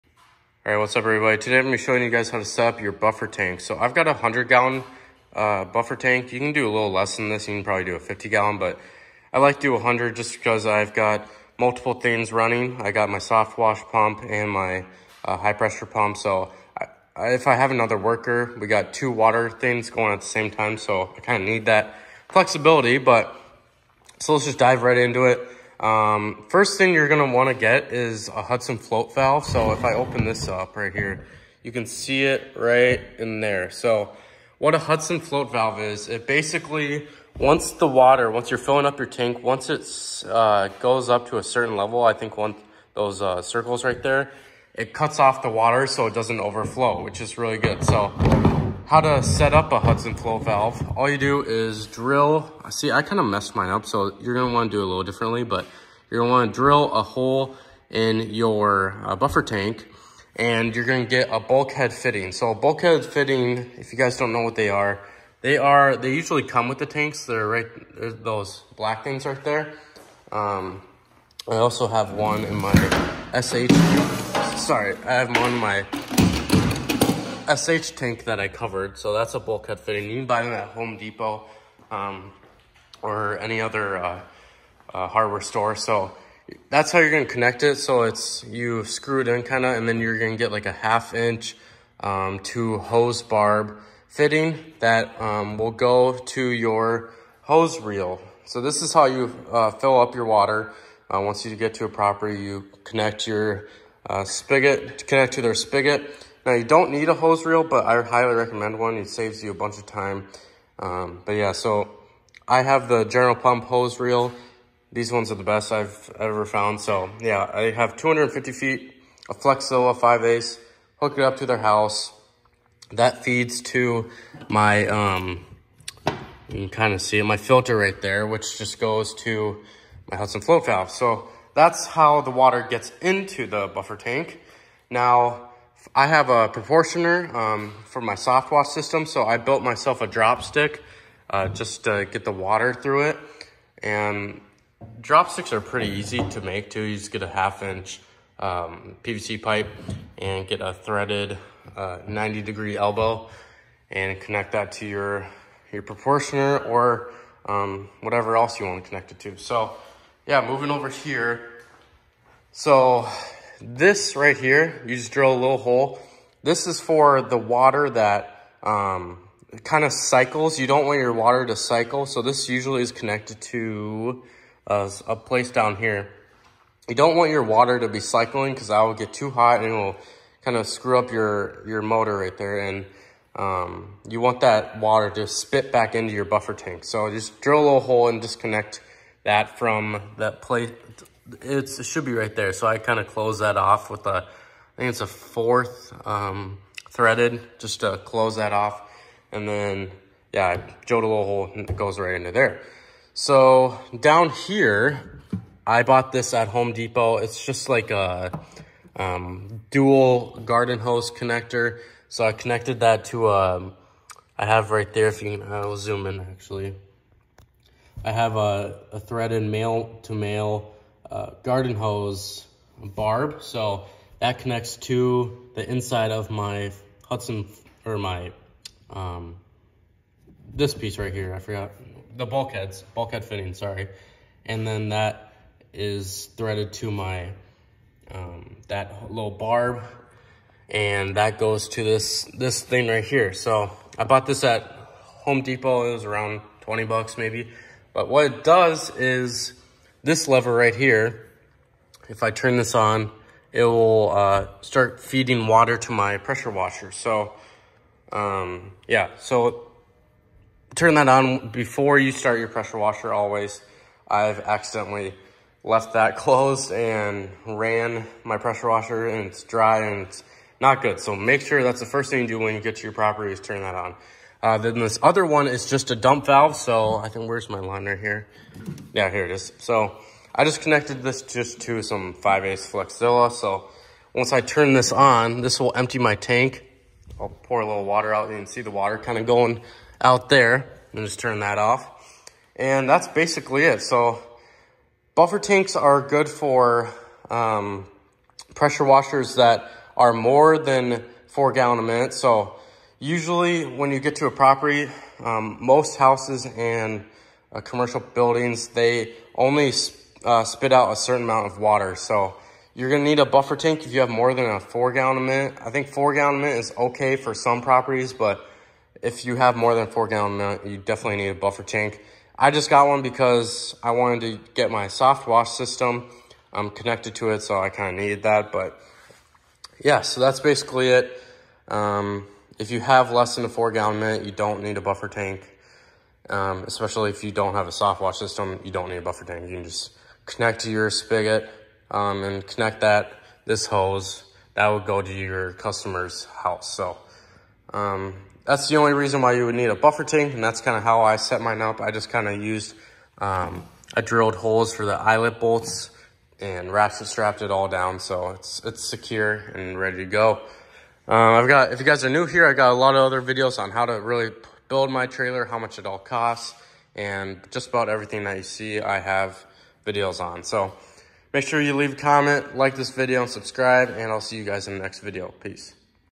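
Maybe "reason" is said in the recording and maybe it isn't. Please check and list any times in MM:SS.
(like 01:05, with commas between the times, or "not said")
05:48.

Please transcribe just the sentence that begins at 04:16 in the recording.
So um, yeah, so turn that on before you start your pressure washer always.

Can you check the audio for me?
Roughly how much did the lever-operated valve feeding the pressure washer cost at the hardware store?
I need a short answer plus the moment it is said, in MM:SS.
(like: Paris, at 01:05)
About $20, at 04:06.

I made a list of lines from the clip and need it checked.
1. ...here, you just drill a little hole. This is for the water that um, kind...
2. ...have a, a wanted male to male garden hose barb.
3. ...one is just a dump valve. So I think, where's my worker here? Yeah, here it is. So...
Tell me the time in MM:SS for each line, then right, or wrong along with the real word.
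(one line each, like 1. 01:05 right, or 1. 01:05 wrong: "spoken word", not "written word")
1. 02:44 right
2. 03:38 wrong: "threaded", not "wanted"
3. 04:35 wrong: "liner", not "worker".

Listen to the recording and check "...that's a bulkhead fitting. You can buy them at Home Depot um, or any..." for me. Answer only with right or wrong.
right.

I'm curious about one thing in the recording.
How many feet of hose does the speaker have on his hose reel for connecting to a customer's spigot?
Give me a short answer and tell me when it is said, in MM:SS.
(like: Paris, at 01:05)
250, at 01:57.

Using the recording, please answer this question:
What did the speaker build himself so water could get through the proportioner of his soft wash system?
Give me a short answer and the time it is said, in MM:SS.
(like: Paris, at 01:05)
A drop stick, at 02:20.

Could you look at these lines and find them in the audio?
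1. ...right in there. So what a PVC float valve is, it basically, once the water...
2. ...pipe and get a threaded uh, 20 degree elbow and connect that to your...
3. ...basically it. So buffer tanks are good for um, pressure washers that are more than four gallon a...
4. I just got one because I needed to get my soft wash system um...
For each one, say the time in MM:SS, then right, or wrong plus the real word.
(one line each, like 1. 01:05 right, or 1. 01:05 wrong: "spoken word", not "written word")
1. 00:32 wrong: "Hudson", not "PVC"
2. 02:29 wrong: "90", not "20"
3. 04:53 right
4. 05:22 wrong: "wanted", not "needed".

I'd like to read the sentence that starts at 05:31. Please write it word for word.
Um, if you have less than a four gallon minute, you don't need a buffer tank.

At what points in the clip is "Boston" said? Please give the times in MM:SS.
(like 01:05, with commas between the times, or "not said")
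not said.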